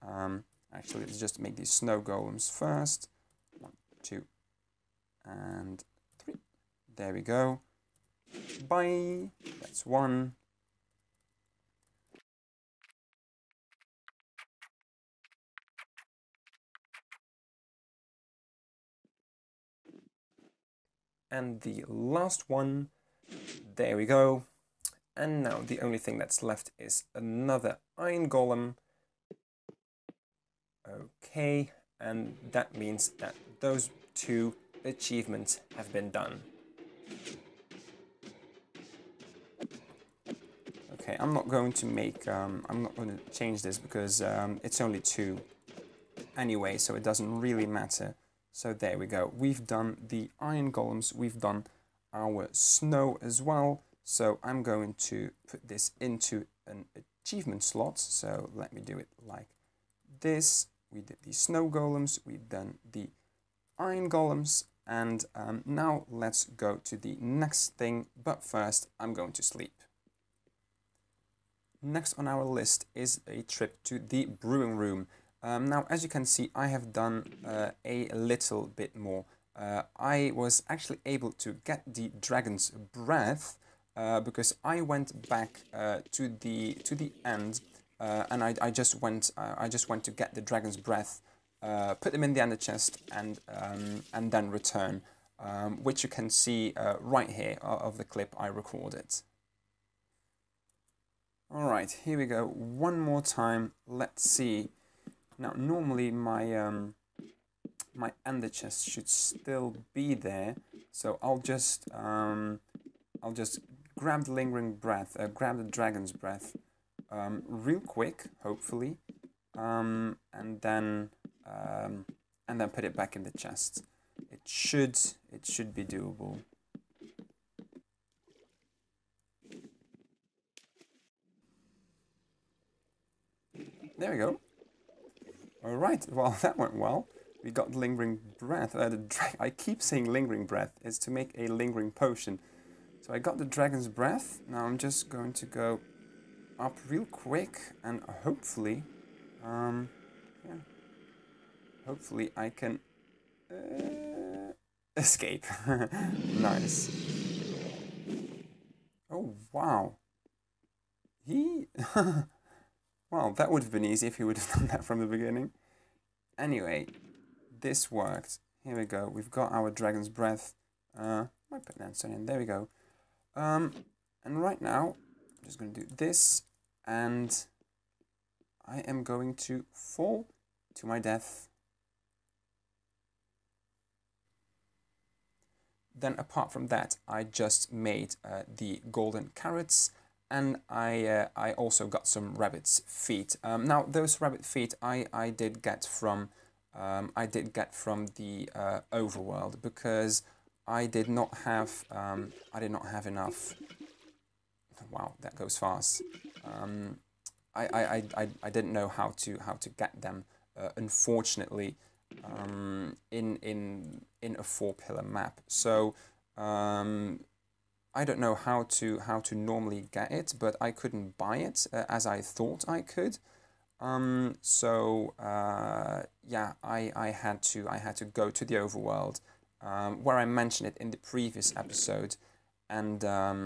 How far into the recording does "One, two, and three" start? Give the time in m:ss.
0:03.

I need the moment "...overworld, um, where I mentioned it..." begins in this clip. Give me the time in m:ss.
3:48.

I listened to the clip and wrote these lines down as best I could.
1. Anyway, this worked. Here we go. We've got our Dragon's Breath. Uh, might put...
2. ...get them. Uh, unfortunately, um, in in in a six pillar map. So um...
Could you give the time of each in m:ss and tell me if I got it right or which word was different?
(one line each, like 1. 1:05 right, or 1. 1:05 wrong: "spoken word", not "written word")
1. 2:46 right
2. 3:29 wrong: "four", not "six".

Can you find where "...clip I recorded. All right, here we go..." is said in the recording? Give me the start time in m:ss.
1:38.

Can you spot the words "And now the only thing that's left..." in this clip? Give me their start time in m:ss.
0:25.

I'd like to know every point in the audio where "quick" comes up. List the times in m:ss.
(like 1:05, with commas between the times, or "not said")
1:57, 2:27.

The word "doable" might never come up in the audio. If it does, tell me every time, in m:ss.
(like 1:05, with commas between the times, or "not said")
2:05.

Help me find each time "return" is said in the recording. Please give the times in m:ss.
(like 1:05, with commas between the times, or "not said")
1:34.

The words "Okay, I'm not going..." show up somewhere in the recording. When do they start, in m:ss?
0:40.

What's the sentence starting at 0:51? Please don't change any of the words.
We've done our snow as well.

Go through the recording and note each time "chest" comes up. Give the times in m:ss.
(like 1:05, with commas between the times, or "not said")
1:32, 1:48, 2:03.